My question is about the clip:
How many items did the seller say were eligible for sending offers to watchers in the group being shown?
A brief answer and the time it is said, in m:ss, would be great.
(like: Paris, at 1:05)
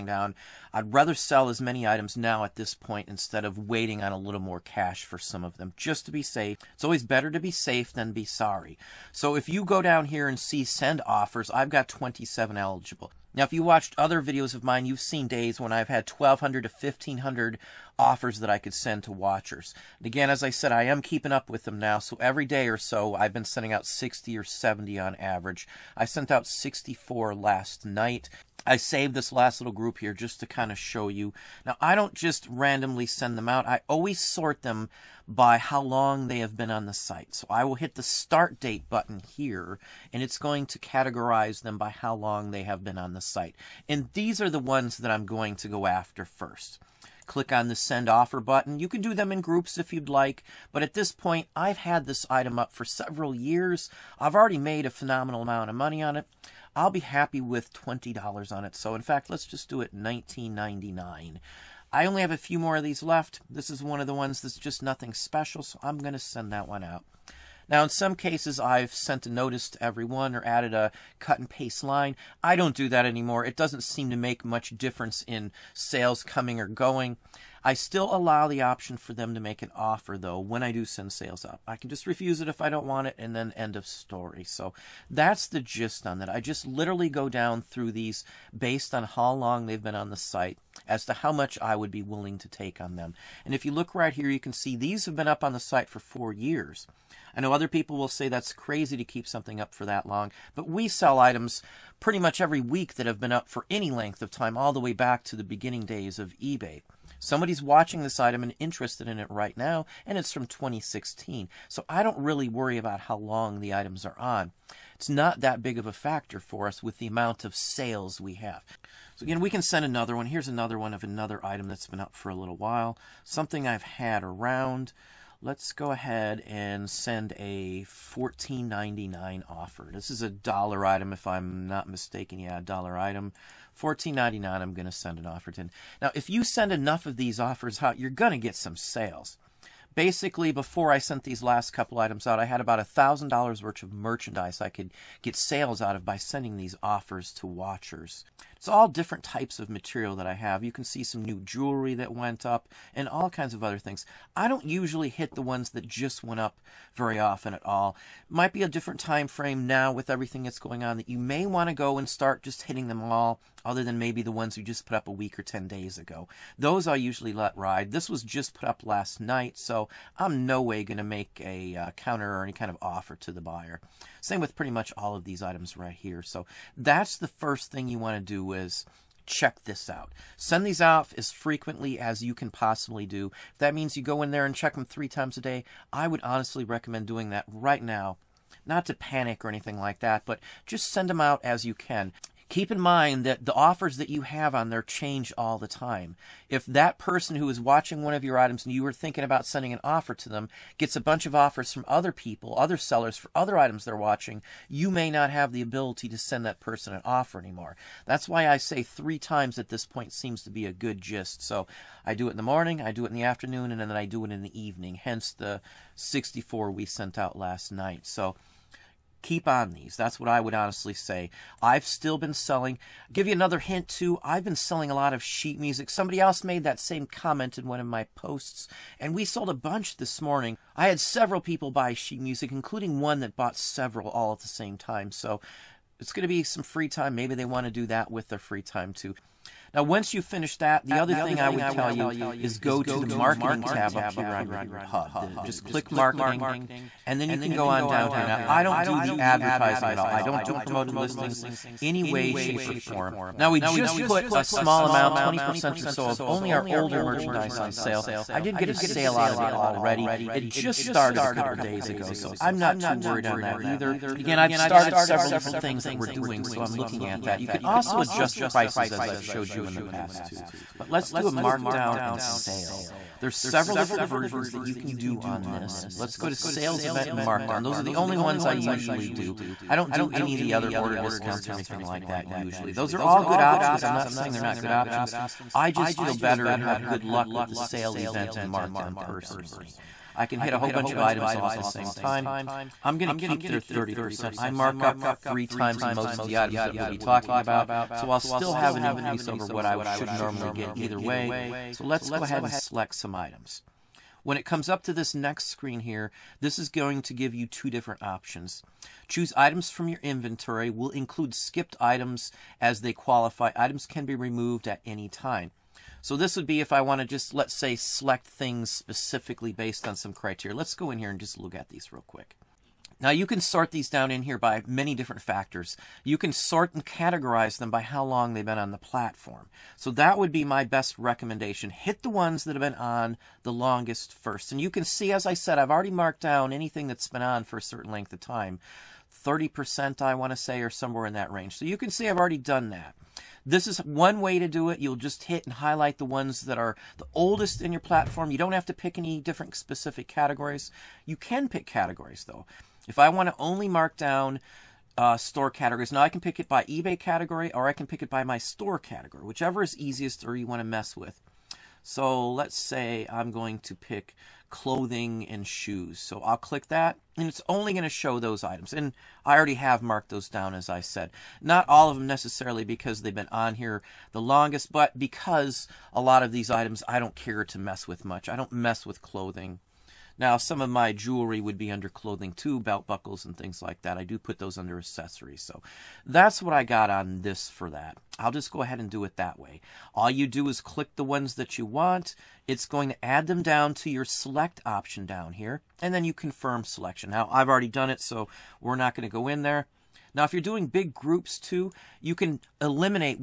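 27, at 0:11.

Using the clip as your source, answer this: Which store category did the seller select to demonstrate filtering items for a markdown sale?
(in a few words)
clothing and shoes.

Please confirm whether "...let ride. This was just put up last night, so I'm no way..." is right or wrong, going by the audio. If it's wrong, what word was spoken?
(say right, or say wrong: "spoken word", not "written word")
right.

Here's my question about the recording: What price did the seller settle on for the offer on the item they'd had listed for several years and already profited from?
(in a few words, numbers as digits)
$19.99.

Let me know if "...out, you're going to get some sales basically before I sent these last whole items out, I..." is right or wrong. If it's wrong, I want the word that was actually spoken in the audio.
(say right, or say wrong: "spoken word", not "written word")
wrong: "couple", not "whole".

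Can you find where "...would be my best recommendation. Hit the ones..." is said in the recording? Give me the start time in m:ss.
5:30.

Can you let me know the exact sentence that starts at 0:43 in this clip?
And these are the ones that I'm going to go after first click on the send offer button.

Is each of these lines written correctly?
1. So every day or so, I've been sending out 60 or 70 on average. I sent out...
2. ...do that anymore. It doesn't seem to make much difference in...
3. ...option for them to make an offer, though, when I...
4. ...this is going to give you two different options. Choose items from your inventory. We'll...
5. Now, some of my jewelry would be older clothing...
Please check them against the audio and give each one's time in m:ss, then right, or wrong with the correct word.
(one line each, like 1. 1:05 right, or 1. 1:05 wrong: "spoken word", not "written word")
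1. 0:21 right
2. 1:12 right
3. 1:18 right
4. 5:06 right
5. 6:20 wrong: "under", not "older".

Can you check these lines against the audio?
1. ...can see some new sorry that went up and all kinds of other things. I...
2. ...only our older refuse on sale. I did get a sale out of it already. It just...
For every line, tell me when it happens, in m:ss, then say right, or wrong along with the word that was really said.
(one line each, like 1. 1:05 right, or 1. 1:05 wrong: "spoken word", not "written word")
1. 2:30 wrong: "jewelry", not "sorry"
2. 4:16 wrong: "merchandise", not "refuse".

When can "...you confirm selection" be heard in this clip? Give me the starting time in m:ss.
6:36.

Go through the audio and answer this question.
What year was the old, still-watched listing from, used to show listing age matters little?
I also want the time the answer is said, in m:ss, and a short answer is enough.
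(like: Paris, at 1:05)
2016, at 1:50.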